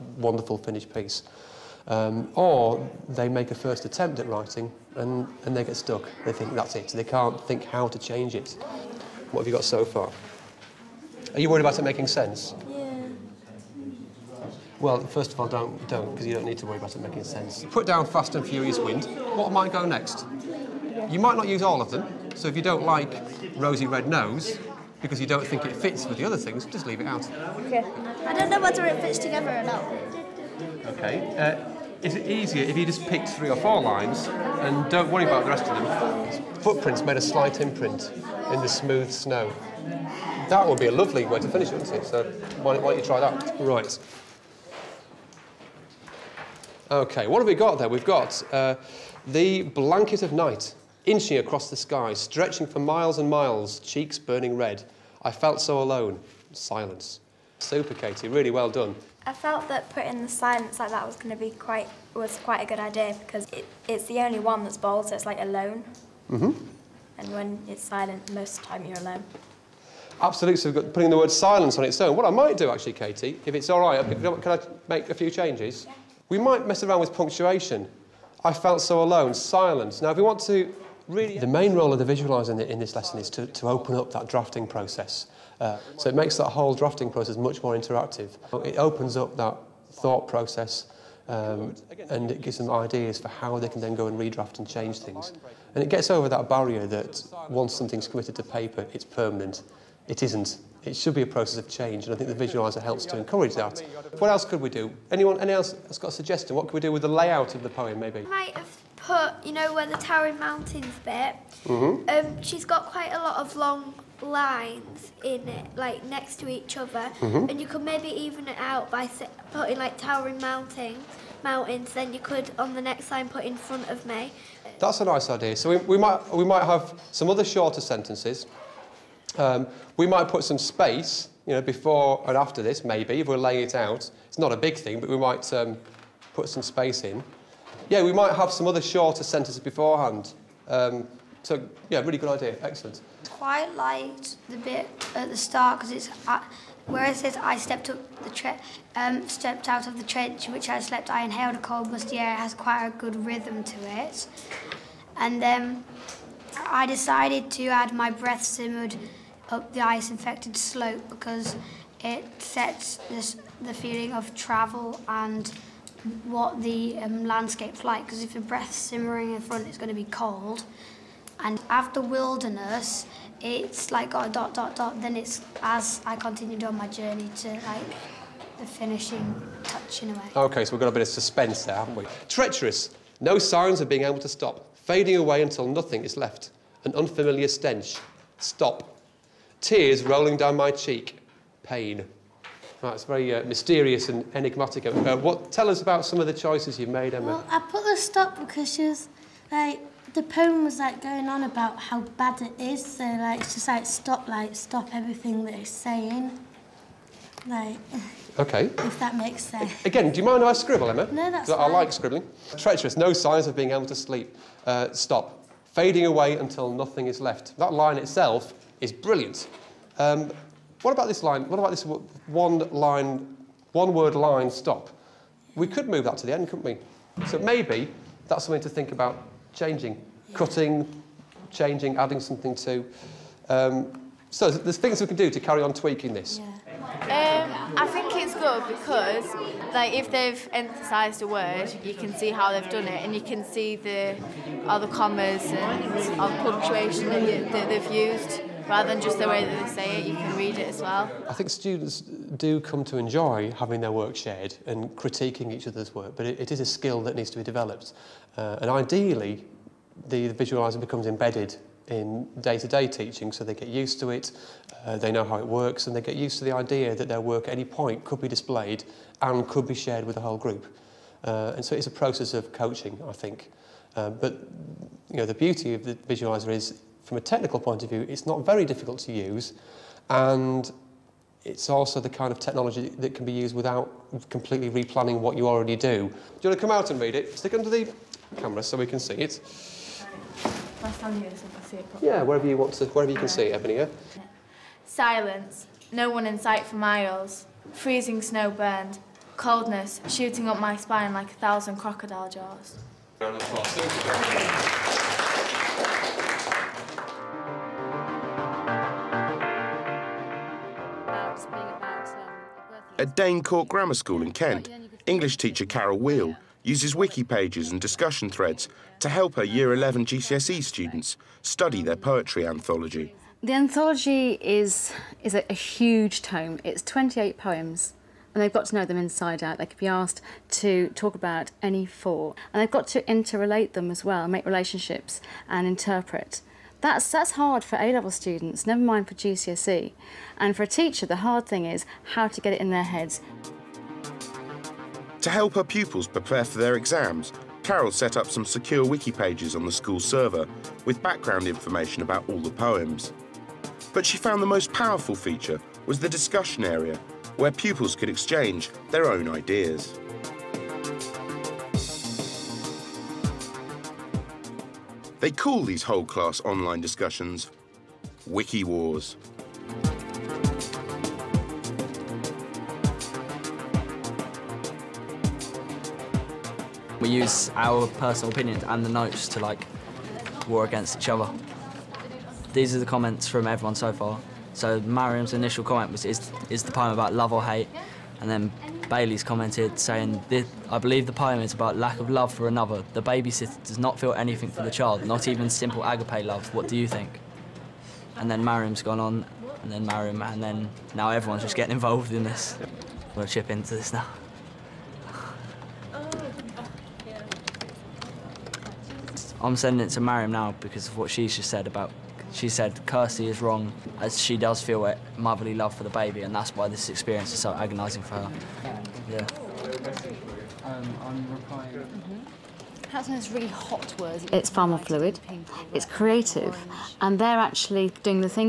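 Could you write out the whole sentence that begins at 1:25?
Uh, so it makes that whole drafting process much more interactive.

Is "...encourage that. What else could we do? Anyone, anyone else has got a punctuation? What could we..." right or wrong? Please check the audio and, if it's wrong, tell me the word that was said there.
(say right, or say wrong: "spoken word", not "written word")
wrong: "suggestion", not "punctuation".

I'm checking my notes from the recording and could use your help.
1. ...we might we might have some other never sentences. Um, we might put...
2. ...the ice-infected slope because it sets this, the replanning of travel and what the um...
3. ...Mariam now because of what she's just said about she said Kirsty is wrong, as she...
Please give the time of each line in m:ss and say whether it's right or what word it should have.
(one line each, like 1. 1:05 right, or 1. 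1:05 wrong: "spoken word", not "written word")
1. 2:05 wrong: "shorter", not "never"
2. 2:39 wrong: "feeling", not "replanning"
3. 6:50 right.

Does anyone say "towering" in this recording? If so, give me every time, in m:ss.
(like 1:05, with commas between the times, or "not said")
1:49, 1:59.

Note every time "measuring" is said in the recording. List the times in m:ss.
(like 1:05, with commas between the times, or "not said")
not said.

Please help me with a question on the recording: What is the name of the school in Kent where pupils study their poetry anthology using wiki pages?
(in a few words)
Dane Court Grammar School.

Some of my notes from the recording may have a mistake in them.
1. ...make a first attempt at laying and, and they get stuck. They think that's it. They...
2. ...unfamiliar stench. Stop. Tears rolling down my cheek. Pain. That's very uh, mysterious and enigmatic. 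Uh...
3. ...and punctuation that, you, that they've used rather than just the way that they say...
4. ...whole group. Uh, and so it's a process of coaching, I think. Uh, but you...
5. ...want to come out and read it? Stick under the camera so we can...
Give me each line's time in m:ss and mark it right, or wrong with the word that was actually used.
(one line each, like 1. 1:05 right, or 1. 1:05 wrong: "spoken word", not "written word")
1. 0:03 wrong: "writing", not "laying"
2. 3:06 right
3. 4:05 right
4. 4:30 right
5. 4:46 right.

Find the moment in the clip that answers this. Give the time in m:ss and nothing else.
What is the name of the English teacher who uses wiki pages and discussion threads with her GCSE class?
5:15.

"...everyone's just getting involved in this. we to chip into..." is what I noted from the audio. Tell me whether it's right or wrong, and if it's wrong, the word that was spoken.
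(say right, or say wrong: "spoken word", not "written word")
right.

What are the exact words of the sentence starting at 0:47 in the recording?
We've got uh, the blanket of night inching across the sky, stretching for miles and miles, cheeks burning red.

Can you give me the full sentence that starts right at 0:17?
Put down Fast and Furious Wind.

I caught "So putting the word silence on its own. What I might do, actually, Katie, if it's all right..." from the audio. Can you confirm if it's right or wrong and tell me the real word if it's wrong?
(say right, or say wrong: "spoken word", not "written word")
right.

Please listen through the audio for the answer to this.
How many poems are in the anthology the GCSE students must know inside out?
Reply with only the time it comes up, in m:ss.
5:26.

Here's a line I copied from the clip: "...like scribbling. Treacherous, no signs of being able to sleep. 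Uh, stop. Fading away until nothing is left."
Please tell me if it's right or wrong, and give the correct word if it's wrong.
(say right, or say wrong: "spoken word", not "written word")
right.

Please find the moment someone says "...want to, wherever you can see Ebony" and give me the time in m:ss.
4:52.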